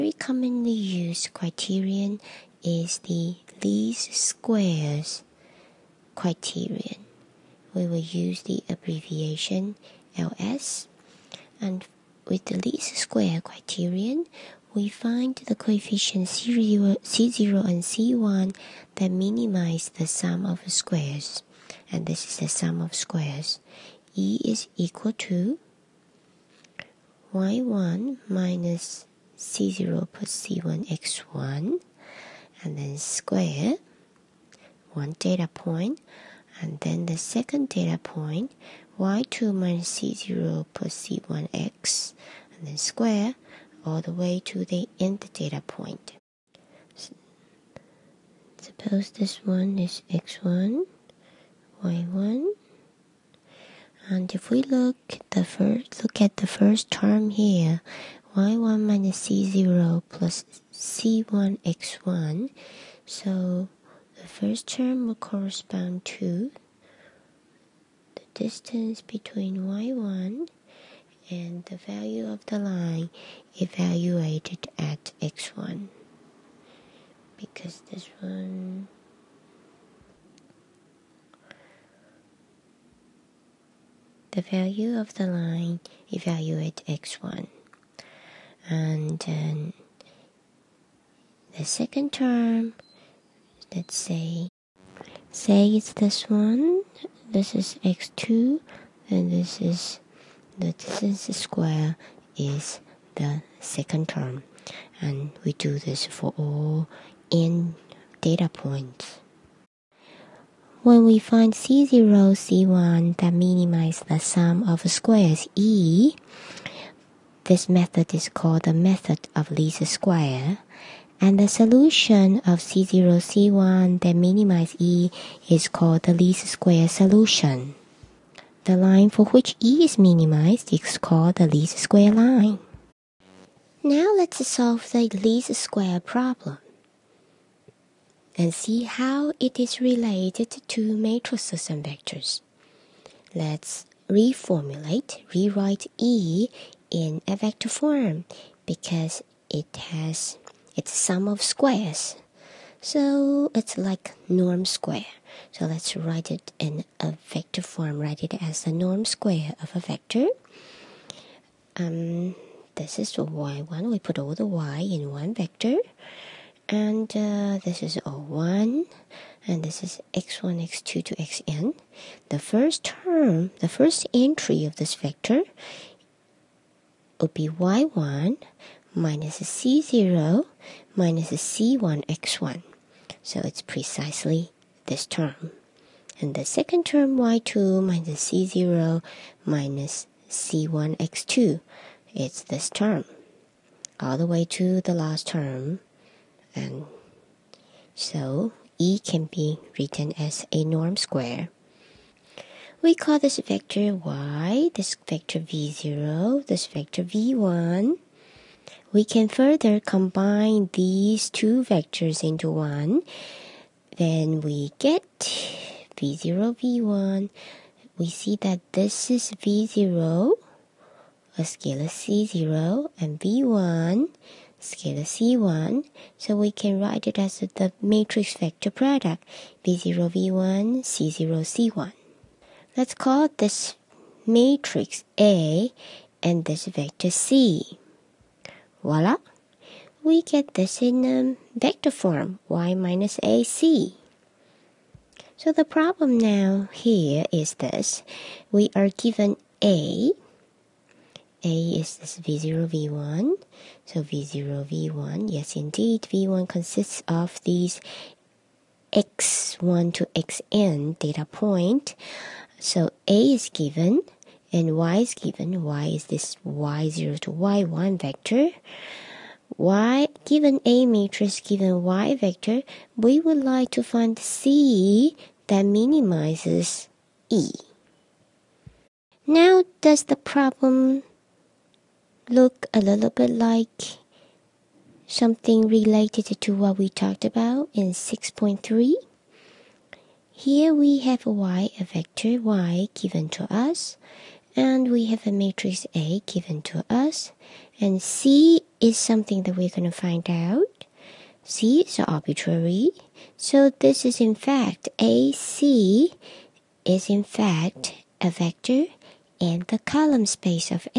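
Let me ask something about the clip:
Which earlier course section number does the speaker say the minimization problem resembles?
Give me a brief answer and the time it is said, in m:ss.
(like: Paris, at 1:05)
6.3, at 4:47.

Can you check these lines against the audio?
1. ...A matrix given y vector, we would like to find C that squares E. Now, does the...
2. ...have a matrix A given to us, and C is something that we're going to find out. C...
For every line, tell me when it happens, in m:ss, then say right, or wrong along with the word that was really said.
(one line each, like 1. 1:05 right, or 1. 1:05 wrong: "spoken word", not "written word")
1. 4:30 wrong: "minimizes", not "squares"
2. 4:55 right.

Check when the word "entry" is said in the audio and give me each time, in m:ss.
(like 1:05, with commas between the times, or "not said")
2:54.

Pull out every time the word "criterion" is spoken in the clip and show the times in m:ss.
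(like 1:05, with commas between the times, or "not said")
0:01, 0:06, 0:13.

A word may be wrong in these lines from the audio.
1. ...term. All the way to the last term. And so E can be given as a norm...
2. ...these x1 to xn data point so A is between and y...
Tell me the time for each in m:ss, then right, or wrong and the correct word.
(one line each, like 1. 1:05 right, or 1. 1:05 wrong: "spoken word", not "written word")
1. 3:12 wrong: "written", not "given"
2. 4:17 wrong: "given", not "between".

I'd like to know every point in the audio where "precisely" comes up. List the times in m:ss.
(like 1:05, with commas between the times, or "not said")
3:03.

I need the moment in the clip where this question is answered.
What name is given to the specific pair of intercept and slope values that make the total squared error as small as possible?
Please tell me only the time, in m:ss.
2:06.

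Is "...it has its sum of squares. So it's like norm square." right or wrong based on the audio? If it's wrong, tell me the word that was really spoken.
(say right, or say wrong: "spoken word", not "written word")
right.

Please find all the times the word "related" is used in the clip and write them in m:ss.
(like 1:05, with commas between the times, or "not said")
2:19, 4:45.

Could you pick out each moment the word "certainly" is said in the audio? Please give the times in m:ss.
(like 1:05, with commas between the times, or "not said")
not said.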